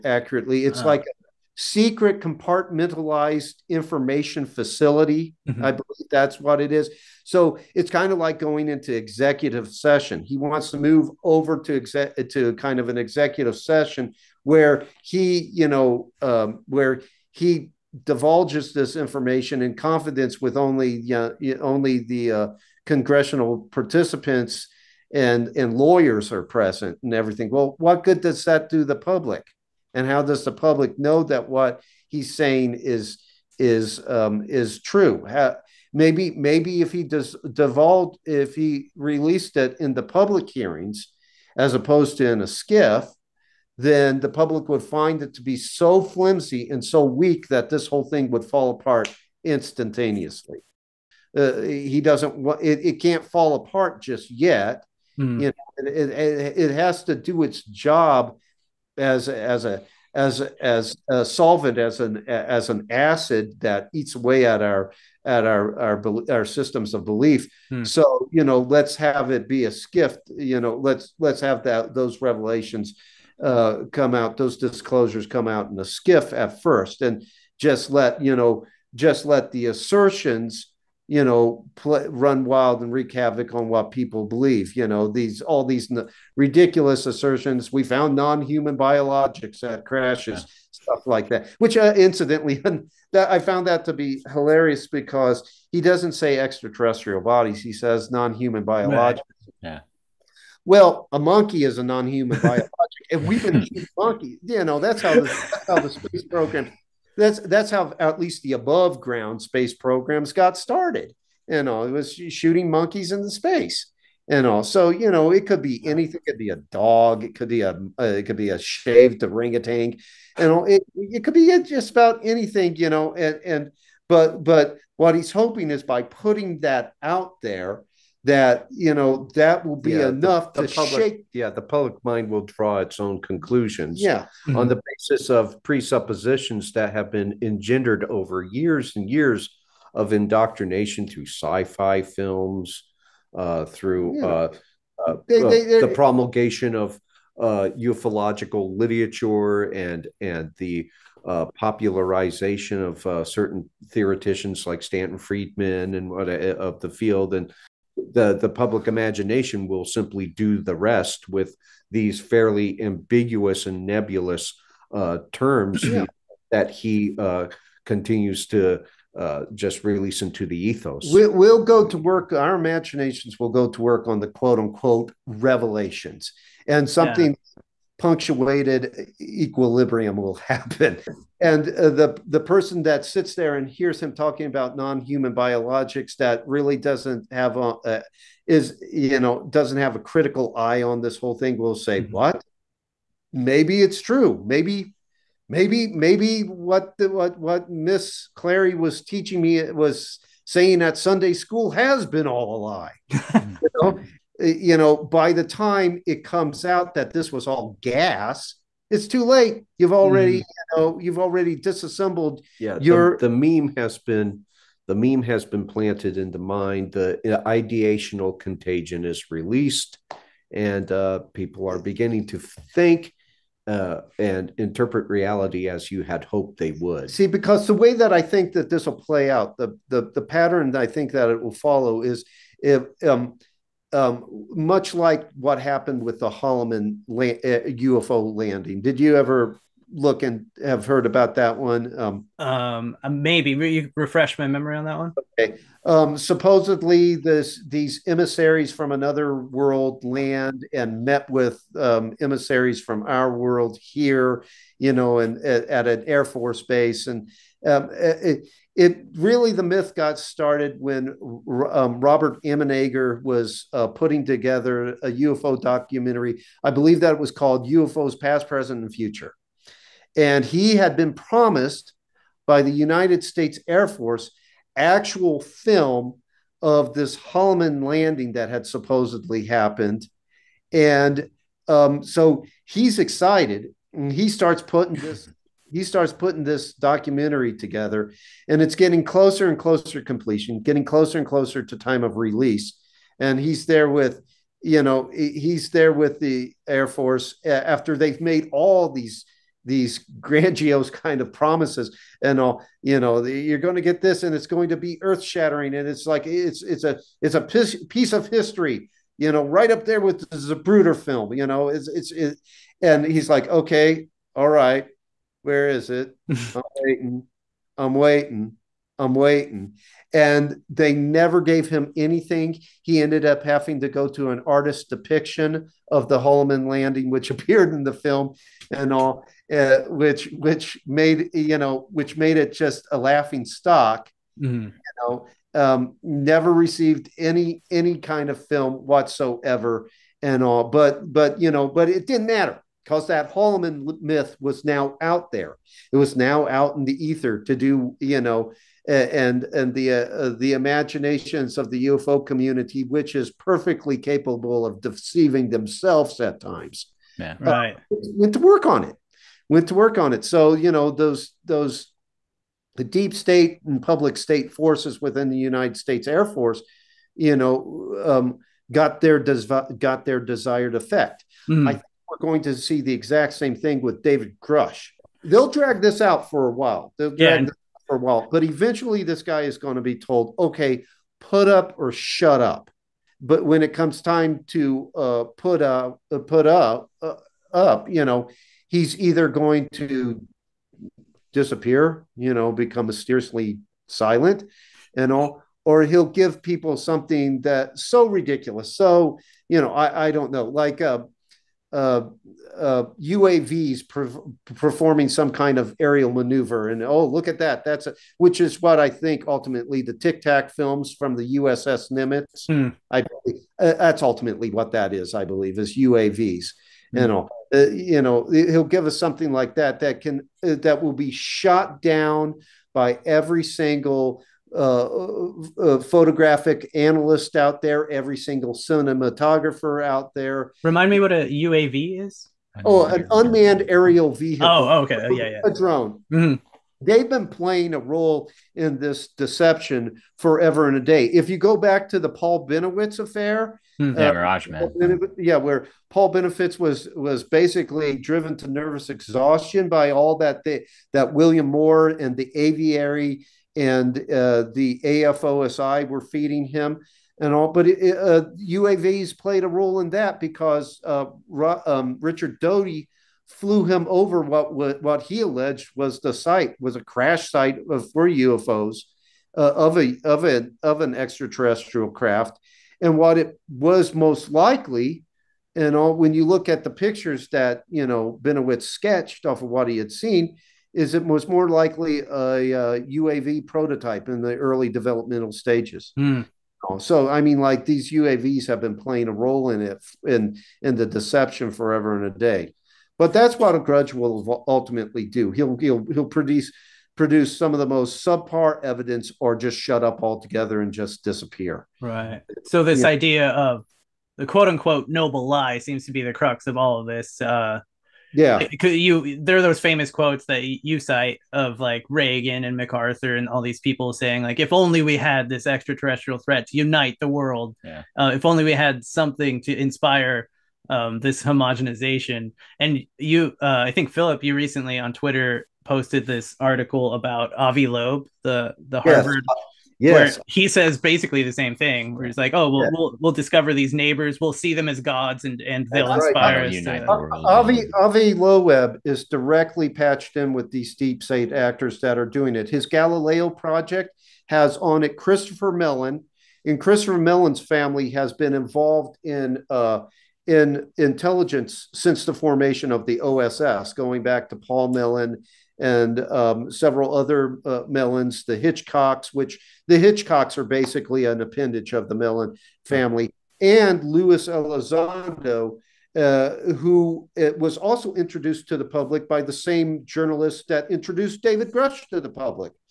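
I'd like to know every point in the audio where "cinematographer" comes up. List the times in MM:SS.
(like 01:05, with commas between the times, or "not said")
07:08.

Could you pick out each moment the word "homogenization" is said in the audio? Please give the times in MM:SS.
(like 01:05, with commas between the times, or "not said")
08:41.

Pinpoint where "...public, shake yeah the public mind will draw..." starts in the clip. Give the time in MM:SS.
02:10.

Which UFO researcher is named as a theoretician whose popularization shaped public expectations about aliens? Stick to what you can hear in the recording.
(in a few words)
Stanton Friedman.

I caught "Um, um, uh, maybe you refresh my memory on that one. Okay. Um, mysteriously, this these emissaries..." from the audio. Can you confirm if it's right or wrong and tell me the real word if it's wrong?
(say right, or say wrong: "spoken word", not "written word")
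wrong: "supposedly", not "mysteriously".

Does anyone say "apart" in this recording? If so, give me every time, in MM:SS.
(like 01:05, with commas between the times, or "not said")
00:48, 00:53.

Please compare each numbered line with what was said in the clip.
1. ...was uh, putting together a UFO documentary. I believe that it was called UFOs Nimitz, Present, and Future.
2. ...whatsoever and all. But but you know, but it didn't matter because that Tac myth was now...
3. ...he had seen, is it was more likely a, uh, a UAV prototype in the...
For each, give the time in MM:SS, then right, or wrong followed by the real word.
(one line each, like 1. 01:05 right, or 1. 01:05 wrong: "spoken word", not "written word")
1. 04:23 wrong: "Past", not "Nimitz"
2. 05:38 wrong: "Holloman", not "Tac"
3. 07:59 right.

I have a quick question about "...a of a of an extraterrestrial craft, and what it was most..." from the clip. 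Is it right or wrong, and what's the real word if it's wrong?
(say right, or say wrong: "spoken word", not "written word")
right.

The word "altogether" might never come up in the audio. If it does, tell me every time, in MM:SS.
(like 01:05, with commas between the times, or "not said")
08:20.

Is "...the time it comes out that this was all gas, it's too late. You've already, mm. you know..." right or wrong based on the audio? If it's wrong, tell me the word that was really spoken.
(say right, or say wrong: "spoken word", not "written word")
right.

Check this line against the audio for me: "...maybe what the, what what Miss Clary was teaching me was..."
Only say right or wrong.
right.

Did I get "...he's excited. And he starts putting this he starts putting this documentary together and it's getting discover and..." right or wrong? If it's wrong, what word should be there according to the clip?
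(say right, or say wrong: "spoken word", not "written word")
wrong: "closer", not "discover".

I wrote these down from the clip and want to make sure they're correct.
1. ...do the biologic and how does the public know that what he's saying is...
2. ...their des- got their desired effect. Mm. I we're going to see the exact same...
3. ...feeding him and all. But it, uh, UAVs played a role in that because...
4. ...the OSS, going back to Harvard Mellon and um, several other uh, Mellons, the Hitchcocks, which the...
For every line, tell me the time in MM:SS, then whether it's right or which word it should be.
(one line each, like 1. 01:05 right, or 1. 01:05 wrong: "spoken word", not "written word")
1. 00:28 wrong: "public", not "biologic"
2. 06:08 right
3. 07:36 right
4. 09:12 wrong: "Paul", not "Harvard".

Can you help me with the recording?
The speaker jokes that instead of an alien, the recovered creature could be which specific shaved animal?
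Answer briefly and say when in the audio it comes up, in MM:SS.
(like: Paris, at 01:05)
orangutan, at 01:59.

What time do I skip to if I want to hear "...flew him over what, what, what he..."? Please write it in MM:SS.
07:43.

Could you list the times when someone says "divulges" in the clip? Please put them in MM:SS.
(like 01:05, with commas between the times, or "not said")
00:18, 00:37.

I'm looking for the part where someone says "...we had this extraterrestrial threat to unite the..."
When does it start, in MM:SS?
08:34.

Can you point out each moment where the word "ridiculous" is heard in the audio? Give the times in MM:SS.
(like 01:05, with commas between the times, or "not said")
01:26, 06:38.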